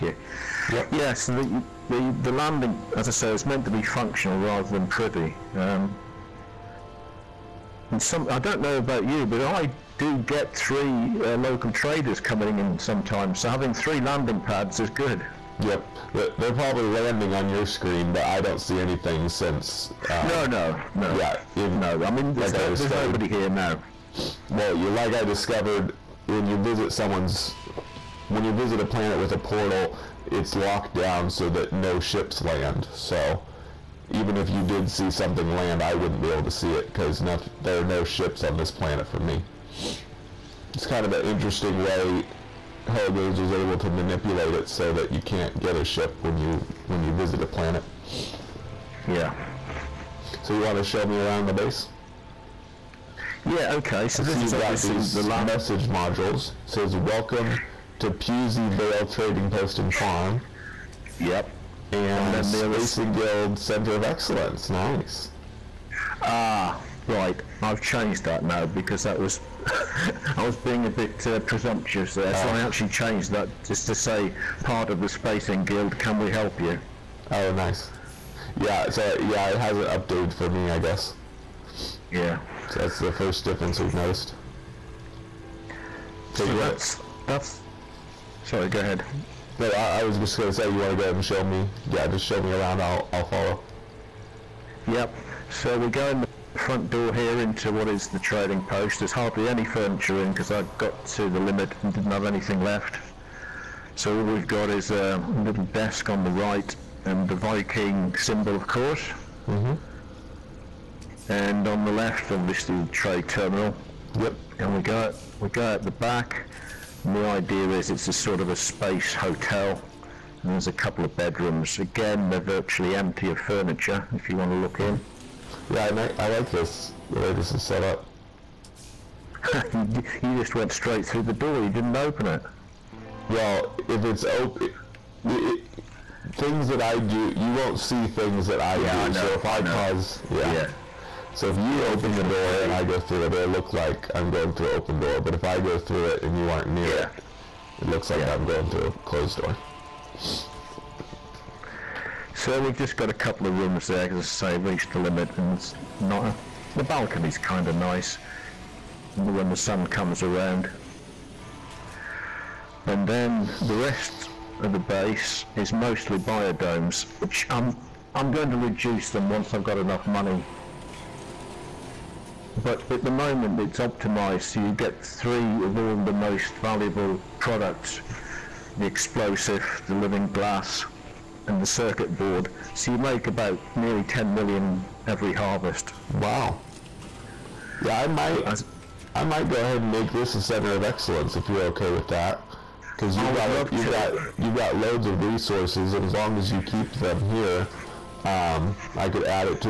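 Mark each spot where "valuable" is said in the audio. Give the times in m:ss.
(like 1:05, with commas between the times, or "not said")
2:56.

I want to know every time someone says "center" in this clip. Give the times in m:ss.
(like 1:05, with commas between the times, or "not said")
1:03, 3:10.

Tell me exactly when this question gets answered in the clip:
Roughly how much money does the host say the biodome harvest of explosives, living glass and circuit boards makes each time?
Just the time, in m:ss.
3:03.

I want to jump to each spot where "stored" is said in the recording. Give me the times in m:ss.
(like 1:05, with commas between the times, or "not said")
not said.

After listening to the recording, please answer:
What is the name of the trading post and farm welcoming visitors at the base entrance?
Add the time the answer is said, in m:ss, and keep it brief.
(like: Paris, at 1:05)
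Pusey Vale, at 0:58.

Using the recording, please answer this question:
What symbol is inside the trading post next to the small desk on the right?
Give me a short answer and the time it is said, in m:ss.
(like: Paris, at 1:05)
Viking symbol, at 1:47.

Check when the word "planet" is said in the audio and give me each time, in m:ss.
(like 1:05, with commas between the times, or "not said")
0:28, 0:38, 0:47.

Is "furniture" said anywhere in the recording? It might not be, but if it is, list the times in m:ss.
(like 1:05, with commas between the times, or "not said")
1:39, 2:03.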